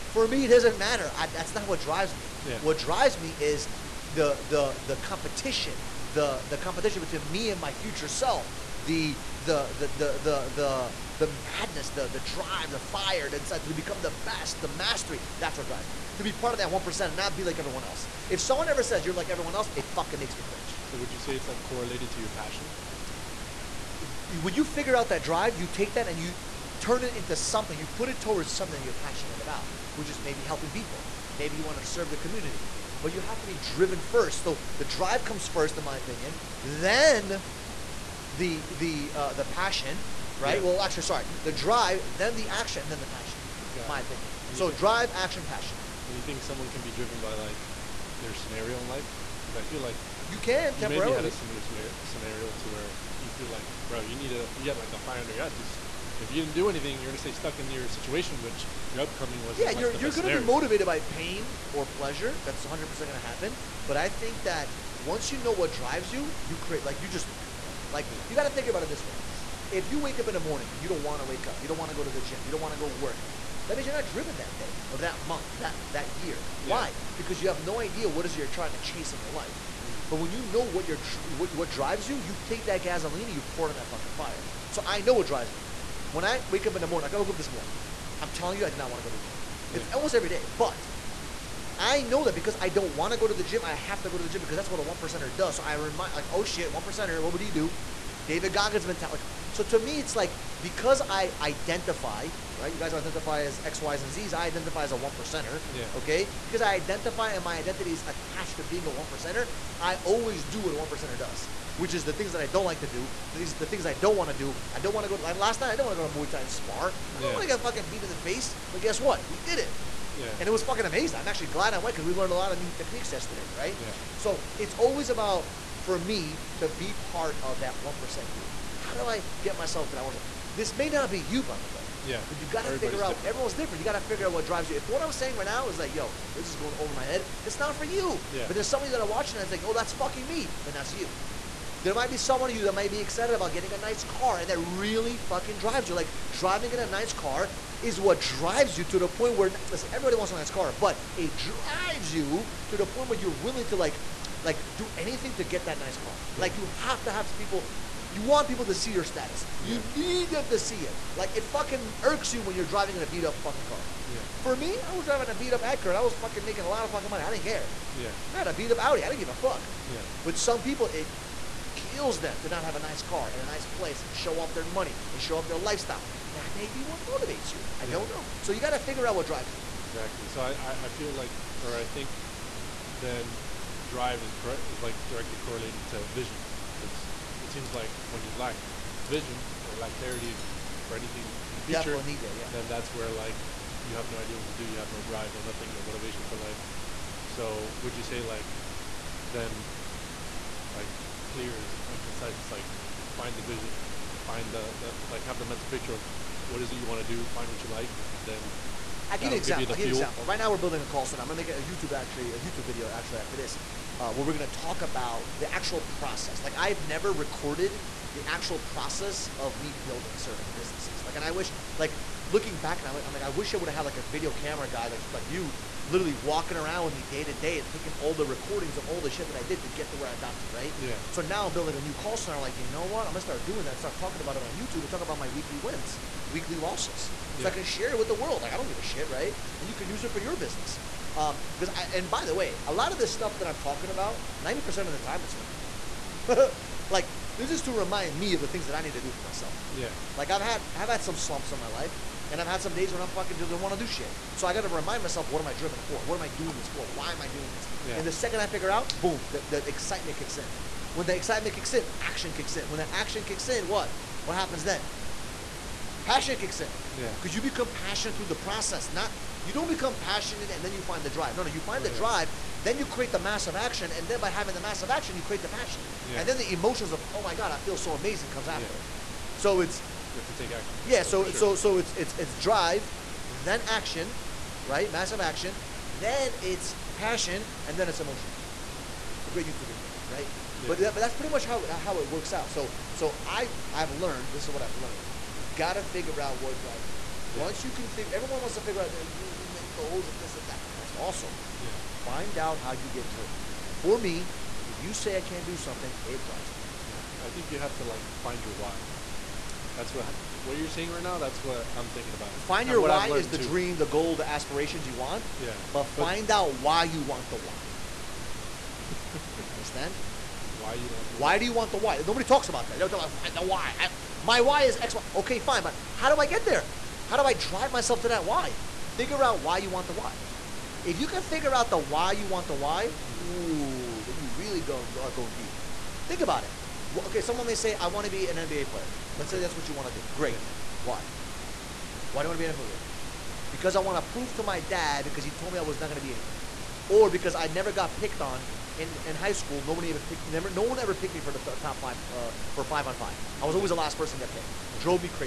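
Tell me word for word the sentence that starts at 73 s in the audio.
That means you're not driven that day or that month, that that year.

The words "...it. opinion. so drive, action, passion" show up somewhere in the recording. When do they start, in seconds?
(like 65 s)
43 s.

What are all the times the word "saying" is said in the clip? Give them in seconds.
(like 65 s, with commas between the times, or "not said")
135 s, 310 s.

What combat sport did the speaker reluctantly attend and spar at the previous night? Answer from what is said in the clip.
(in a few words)
Muay Thai.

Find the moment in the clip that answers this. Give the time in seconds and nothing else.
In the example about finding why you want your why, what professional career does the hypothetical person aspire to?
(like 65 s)
338 s.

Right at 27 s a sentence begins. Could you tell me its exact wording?
You put it towards something that you're passionate about which is maybe mm.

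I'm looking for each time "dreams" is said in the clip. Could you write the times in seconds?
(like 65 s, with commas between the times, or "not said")
299 s, 313 s.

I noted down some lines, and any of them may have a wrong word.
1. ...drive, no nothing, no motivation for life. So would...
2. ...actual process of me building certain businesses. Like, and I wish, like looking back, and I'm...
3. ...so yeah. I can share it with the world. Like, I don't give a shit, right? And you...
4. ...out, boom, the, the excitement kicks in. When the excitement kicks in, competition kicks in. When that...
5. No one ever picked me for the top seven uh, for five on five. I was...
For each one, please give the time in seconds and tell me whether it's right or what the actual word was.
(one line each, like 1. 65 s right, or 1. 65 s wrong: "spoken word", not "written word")
1. 195 s right
2. 218 s right
3. 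237 s right
4. 258 s wrong: "action", not "competition"
5. 350 s wrong: "five", not "seven".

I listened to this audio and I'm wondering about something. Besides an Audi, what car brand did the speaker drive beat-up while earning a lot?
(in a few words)
Acura.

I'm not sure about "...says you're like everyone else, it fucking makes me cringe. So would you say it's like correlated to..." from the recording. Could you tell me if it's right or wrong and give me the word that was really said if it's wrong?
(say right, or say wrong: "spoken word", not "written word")
right.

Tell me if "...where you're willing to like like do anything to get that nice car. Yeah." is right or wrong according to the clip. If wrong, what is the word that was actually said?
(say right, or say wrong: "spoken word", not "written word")
right.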